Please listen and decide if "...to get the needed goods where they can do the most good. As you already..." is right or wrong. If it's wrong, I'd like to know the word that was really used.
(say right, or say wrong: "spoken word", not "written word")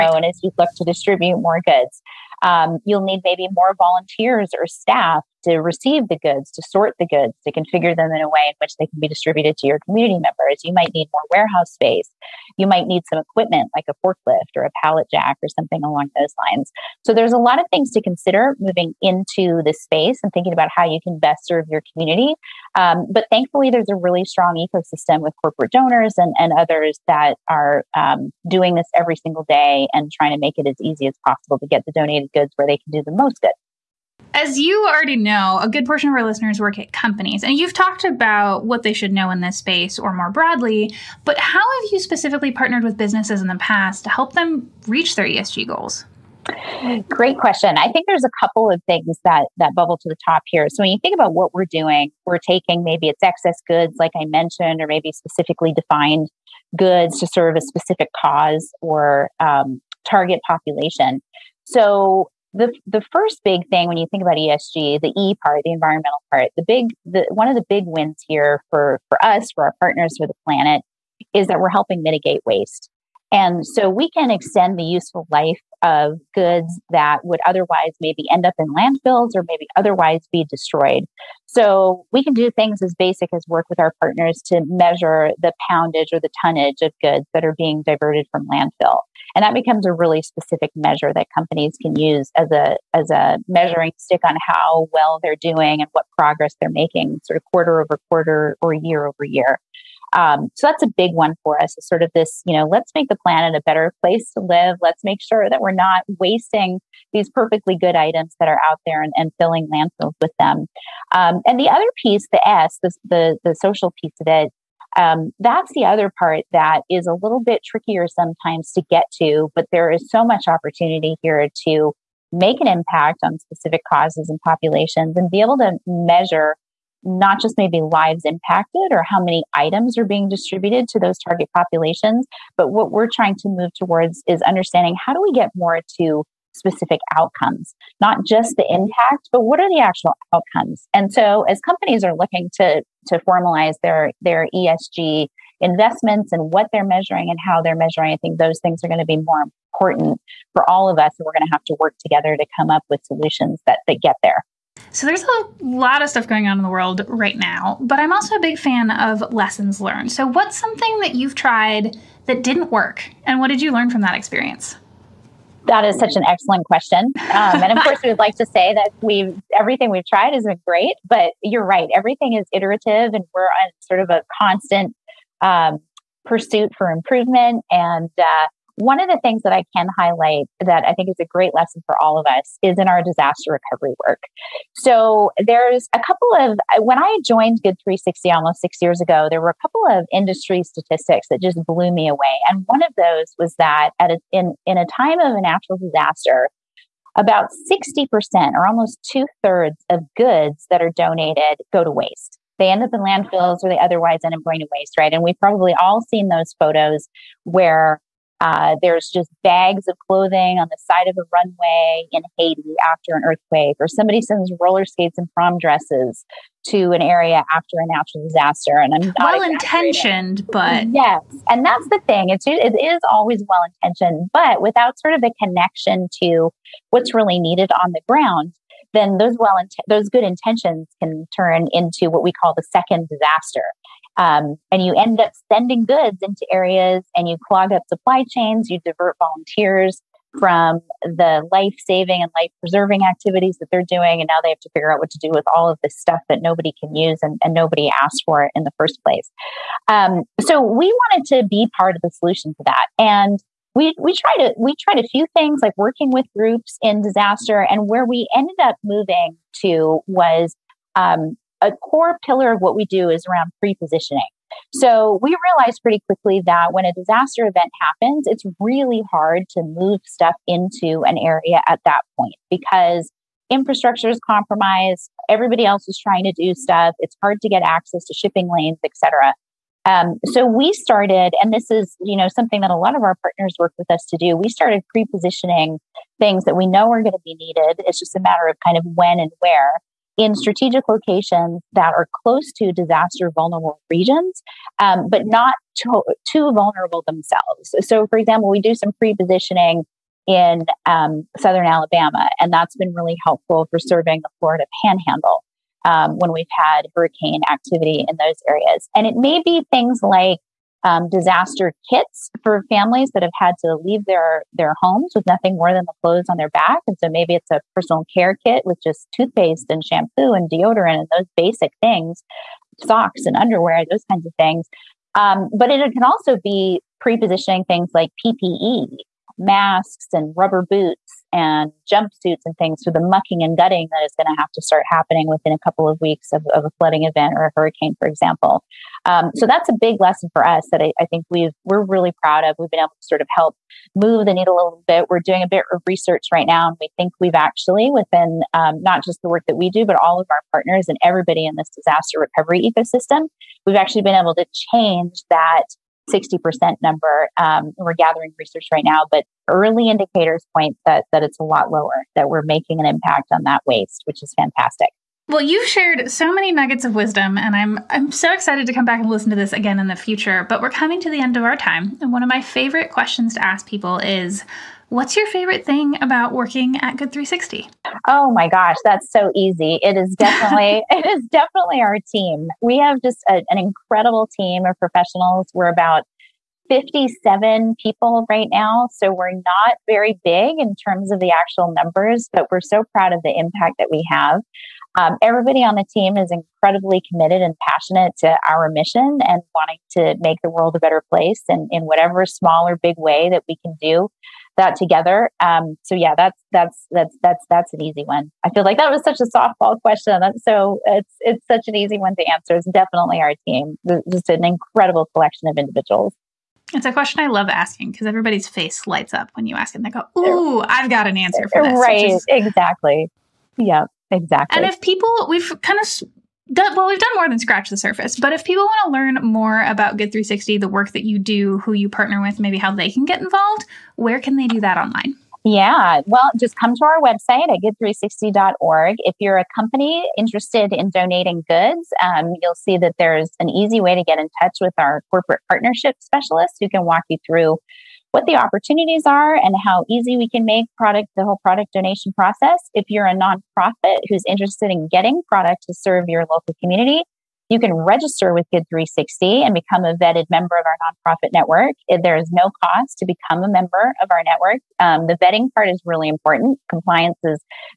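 wrong: "donated", not "needed".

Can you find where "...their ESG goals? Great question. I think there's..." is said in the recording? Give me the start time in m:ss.
0:45.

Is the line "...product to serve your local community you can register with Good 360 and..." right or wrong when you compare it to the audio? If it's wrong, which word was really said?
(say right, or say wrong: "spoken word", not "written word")
right.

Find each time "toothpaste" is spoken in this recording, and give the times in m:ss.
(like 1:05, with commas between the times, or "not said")
5:19.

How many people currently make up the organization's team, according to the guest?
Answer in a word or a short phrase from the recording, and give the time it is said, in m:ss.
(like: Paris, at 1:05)
57, at 6:26.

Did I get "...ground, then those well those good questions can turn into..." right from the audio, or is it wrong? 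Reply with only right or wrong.
wrong.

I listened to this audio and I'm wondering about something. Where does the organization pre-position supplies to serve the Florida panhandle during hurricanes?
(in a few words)
Southern Alabama.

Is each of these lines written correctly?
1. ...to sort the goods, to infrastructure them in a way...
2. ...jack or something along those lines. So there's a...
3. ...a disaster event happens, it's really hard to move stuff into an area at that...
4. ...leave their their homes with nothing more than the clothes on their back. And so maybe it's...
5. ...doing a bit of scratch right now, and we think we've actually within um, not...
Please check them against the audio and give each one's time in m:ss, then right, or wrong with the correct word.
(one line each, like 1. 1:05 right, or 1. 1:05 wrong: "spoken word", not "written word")
1. 0:06 wrong: "configure", not "infrastructure"
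2. 0:15 right
3. 4:26 right
4. 5:13 right
5. 5:45 wrong: "research", not "scratch".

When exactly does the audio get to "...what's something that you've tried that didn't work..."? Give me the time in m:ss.
2:40.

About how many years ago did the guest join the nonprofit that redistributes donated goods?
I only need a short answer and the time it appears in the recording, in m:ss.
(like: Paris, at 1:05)
6, at 3:08.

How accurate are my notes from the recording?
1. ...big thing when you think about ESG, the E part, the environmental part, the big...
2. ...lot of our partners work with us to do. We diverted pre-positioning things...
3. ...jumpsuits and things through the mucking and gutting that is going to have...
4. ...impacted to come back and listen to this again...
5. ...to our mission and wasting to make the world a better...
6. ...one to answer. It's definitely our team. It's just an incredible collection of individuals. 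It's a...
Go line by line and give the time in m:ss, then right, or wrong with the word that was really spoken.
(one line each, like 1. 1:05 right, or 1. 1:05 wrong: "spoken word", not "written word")
1. 1:03 right
2. 4:42 wrong: "started", not "diverted"
3. 5:31 right
4. 6:08 wrong: "excited", not "impacted"
5. 6:38 wrong: "wanting", not "wasting"
6. 6:51 right.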